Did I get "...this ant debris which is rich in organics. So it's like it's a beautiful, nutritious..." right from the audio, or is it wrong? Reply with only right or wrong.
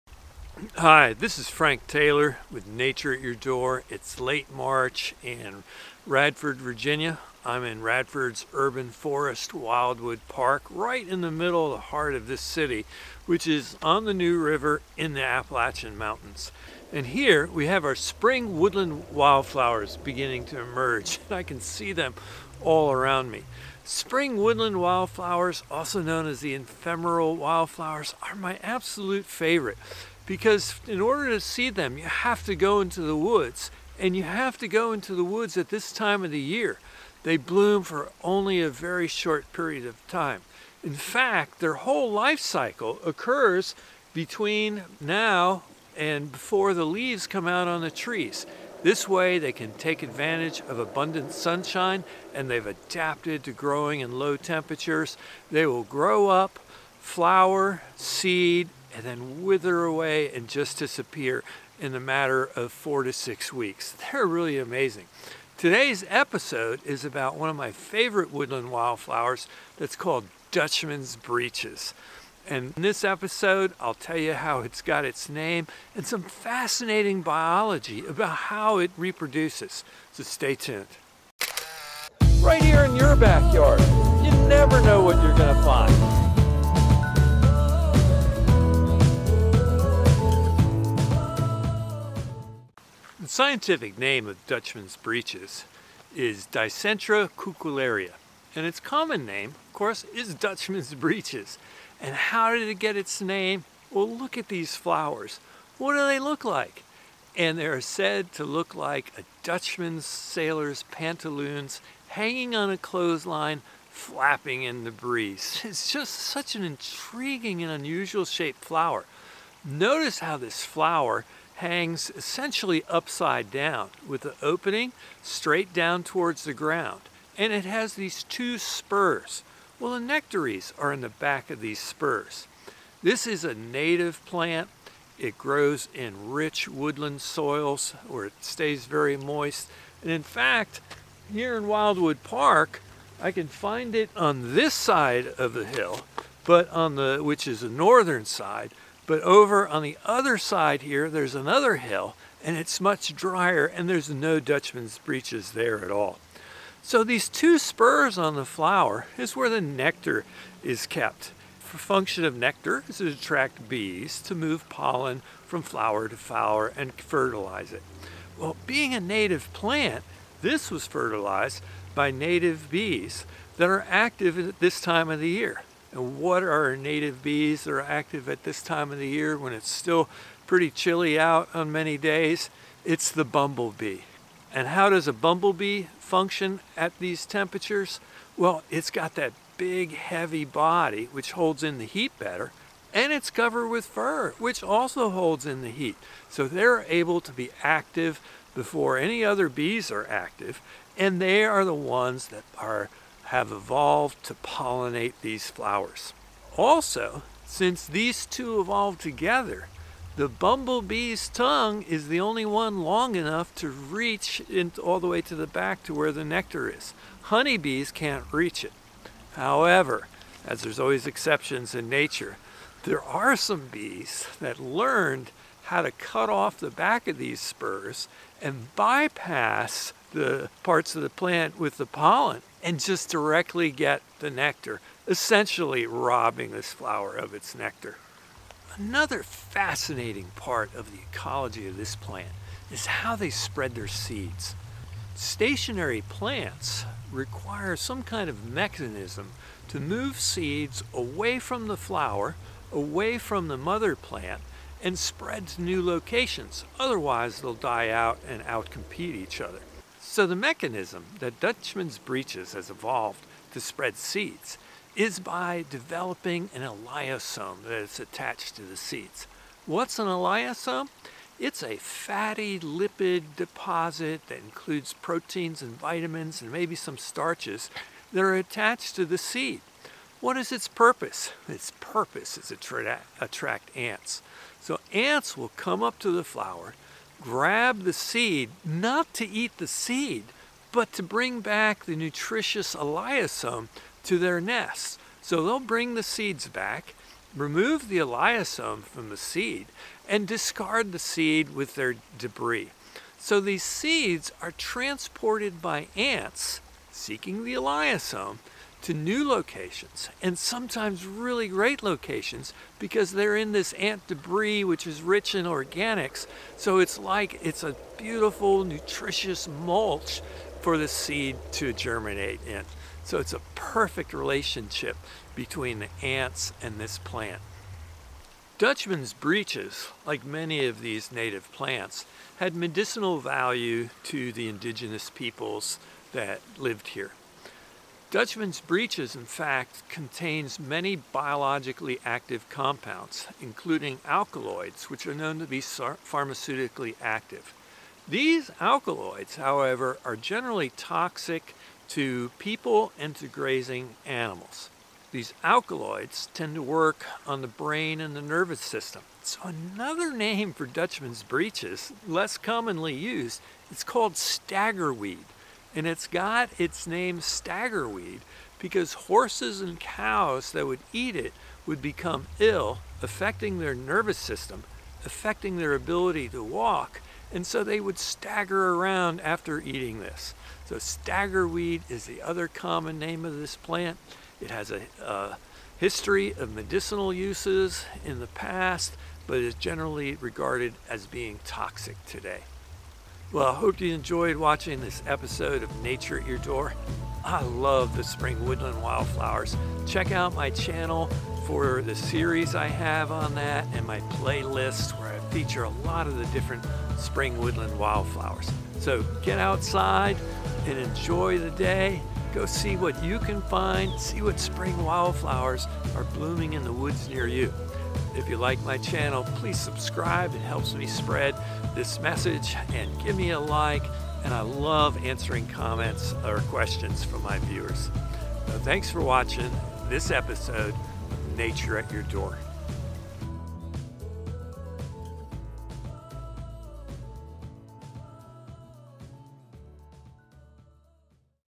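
right.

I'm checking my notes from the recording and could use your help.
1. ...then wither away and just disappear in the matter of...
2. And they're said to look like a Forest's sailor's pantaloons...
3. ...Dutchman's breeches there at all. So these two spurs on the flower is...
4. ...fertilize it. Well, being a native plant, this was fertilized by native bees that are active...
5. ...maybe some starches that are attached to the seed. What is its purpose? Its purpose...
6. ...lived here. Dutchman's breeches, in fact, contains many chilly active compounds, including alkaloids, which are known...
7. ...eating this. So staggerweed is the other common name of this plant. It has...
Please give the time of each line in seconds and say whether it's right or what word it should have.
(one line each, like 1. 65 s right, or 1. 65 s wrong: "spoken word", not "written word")
1. 59 s right
2. 107 s wrong: "Dutchman", not "Forest"
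3. 154 s right
4. 166 s right
5. 276 s right
6. 336 s wrong: "biologically", not "chilly"
7. 379 s right.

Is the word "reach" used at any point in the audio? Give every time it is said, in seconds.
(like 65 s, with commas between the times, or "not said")
213 s, 218 s.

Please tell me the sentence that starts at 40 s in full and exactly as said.
In fact, their whole life cycle occurs between now and before the leaves come out on the trees.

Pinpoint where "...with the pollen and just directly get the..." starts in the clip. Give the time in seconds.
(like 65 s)
231 s.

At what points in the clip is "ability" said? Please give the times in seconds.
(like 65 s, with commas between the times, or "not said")
375 s.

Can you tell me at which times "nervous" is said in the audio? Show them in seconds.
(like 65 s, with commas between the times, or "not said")
358 s, 373 s.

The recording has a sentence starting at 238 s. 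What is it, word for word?
Another fascinating part of the ecology of this plant is how they spread their seeds.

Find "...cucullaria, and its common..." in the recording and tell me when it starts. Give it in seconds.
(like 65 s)
97 s.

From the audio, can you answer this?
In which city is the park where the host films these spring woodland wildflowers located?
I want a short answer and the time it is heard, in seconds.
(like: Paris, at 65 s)
Radford, Virginia, at 6 s.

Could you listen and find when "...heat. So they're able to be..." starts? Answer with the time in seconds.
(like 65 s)
195 s.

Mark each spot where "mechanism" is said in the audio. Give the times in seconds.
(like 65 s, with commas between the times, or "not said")
248 s, 260 s.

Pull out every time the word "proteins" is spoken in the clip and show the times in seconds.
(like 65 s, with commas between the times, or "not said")
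274 s.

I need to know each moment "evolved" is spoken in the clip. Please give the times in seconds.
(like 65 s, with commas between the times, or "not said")
203 s, 208 s, 262 s.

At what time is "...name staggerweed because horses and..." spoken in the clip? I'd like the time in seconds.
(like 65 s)
366 s.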